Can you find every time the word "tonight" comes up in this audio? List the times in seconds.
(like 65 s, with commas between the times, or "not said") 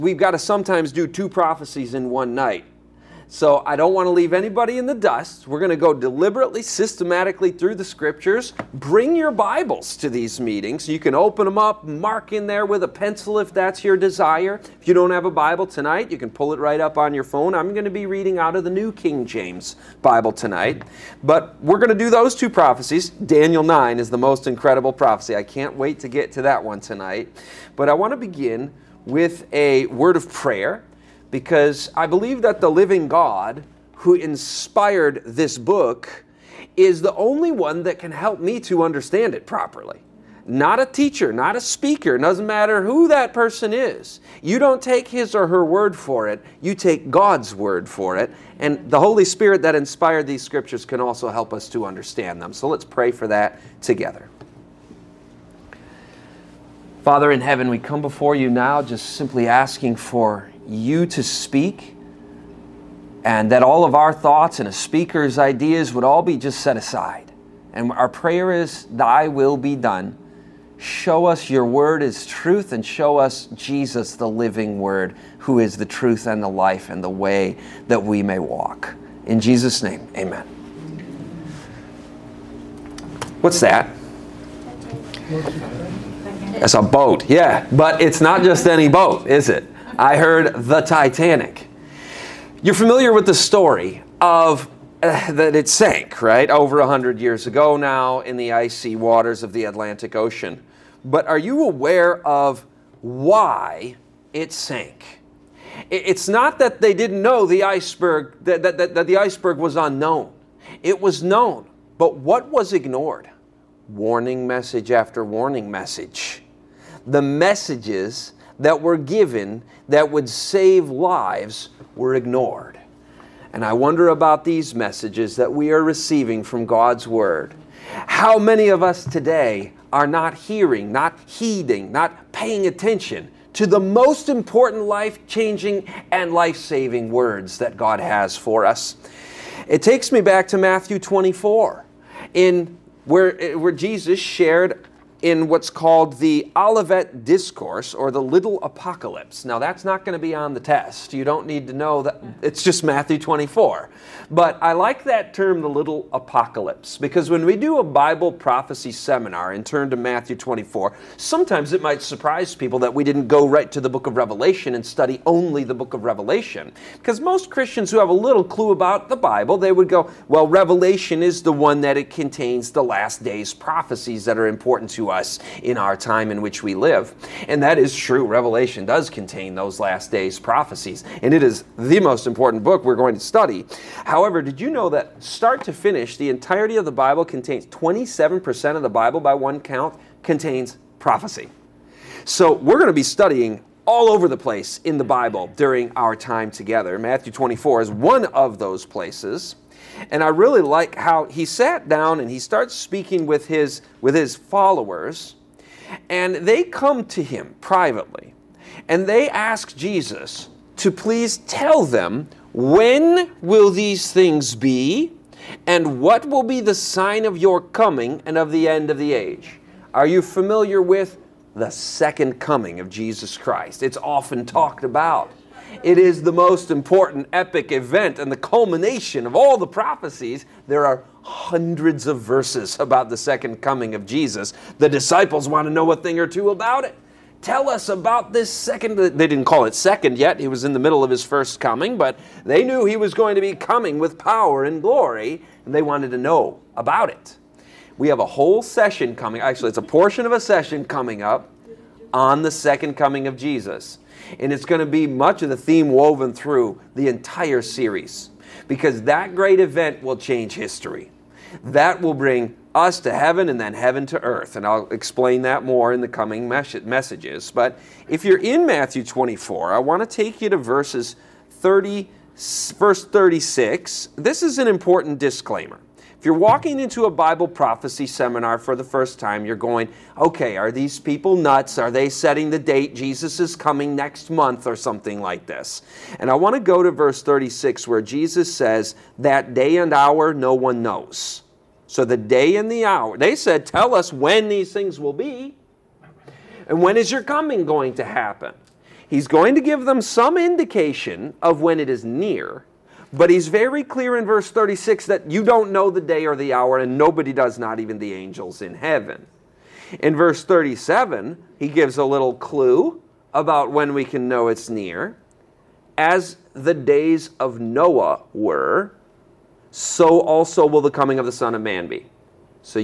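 15 s, 20 s, 26 s.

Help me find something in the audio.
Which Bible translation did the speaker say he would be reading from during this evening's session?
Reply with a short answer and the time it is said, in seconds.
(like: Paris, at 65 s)
New King James, at 18 s.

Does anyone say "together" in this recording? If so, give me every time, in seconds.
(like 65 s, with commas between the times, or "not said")
53 s, 196 s.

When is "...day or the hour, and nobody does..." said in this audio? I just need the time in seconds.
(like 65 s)
306 s.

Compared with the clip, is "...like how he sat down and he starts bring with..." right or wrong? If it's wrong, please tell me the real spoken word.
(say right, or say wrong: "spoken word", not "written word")
wrong: "speaking", not "bring".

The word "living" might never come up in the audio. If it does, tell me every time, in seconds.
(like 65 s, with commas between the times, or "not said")
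32 s, 74 s.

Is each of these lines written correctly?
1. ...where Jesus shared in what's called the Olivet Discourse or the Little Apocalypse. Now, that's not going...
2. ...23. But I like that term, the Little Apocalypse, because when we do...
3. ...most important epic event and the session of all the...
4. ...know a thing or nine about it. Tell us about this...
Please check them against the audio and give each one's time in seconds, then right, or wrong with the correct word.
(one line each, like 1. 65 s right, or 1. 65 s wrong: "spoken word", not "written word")
1. 143 s right
2. 153 s wrong: "24", not "23"
3. 226 s wrong: "culmination", not "session"
4. 235 s wrong: "two", not "nine".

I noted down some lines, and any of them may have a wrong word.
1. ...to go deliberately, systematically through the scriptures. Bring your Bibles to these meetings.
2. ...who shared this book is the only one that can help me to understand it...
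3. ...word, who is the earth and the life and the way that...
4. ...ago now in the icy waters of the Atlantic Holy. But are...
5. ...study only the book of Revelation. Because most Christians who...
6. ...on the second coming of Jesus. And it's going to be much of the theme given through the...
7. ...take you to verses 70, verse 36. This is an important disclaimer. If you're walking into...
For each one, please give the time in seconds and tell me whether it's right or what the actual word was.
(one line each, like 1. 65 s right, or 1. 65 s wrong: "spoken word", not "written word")
1. 5 s right
2. 33 s wrong: "inspired", not "shared"
3. 74 s wrong: "truth", not "earth"
4. 97 s wrong: "Ocean", not "Holy"
5. 164 s right
6. 252 s wrong: "woven", not "given"
7. 270 s wrong: "30", not "70".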